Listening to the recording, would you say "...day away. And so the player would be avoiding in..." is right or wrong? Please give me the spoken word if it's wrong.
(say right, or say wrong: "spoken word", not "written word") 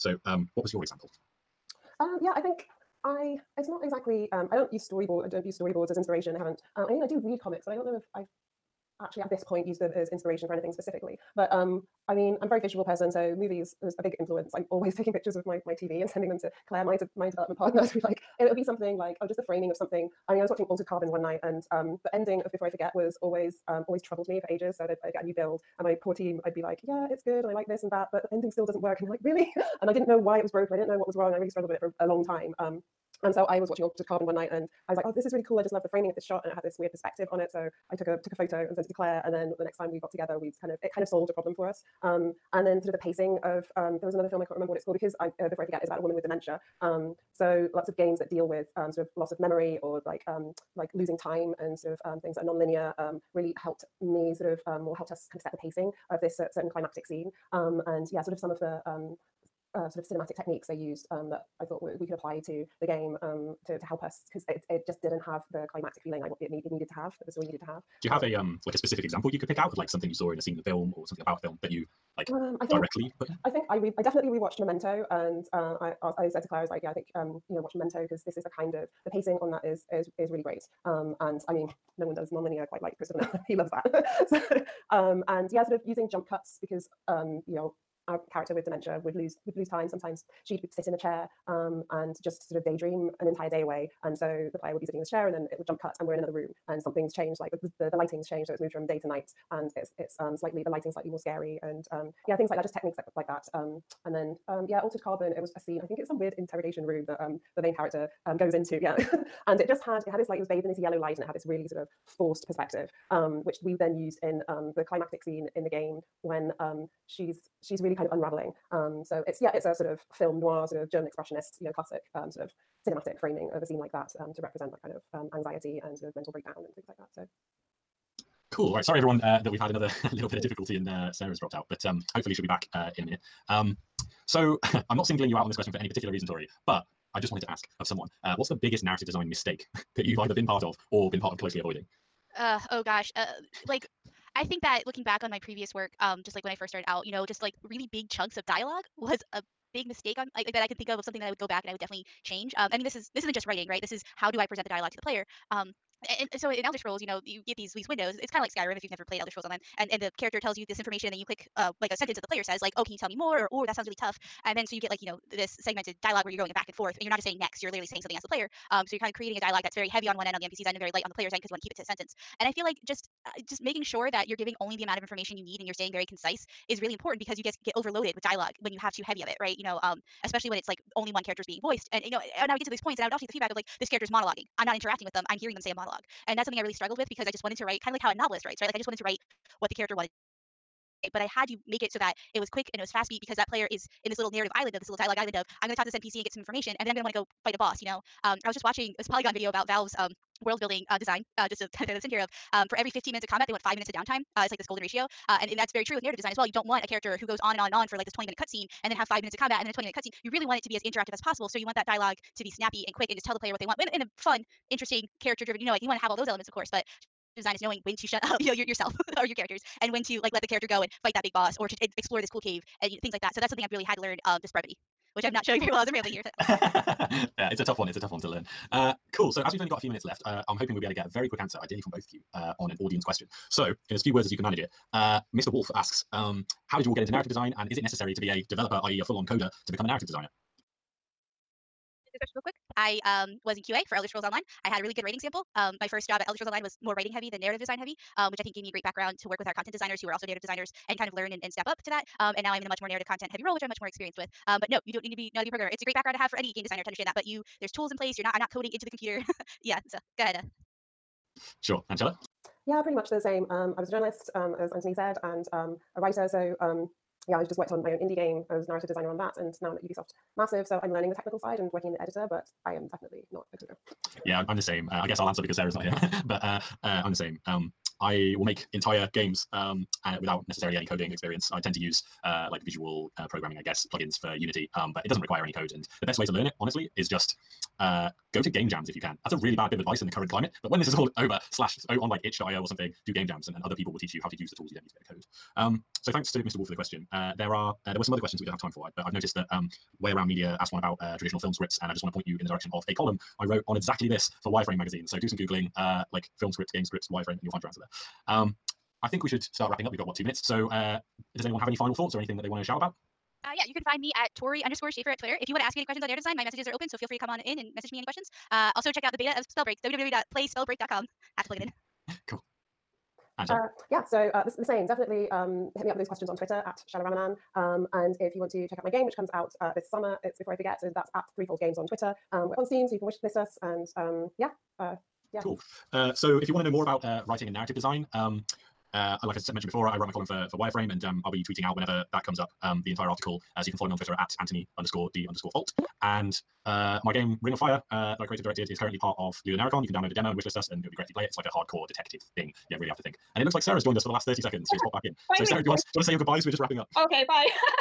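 wrong: "sitting", not "avoiding".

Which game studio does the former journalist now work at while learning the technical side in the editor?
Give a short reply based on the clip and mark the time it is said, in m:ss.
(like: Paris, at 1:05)
Ubisoft Massive, at 4:29.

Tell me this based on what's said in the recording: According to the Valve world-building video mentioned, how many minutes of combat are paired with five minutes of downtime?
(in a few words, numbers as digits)
15.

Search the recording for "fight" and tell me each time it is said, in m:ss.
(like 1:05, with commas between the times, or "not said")
3:17, 3:41.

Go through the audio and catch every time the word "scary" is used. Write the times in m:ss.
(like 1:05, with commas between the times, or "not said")
1:41.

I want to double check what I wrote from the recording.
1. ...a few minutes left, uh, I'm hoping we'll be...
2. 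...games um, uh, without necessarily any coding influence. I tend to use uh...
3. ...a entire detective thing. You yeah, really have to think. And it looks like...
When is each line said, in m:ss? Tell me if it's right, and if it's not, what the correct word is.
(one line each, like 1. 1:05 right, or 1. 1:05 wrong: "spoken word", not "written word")
1. 3:49 right
2. 4:39 wrong: "experience", not "influence"
3. 5:51 wrong: "hardcore", not "entire".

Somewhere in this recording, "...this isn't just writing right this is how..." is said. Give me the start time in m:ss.
2:33.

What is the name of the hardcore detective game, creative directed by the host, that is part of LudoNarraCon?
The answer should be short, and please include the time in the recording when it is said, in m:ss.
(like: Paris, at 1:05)
Ring of Fire, at 5:47.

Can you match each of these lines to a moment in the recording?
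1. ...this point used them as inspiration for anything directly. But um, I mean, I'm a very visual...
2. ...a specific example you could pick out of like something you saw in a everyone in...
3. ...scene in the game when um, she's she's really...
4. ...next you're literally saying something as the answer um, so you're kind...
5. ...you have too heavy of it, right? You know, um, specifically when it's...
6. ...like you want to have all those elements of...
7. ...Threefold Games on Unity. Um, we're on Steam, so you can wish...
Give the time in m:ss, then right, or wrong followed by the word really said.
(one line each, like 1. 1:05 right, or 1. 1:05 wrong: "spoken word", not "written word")
1. 0:09 wrong: "specifically", not "directly"
2. 1:08 wrong: "scene", not "everyone"
3. 1:55 right
4. 2:47 wrong: "player", not "answer"
5. 2:58 wrong: "especially", not "specifically"
6. 3:35 right
7. 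5:31 wrong: "Twitter", not "Unity".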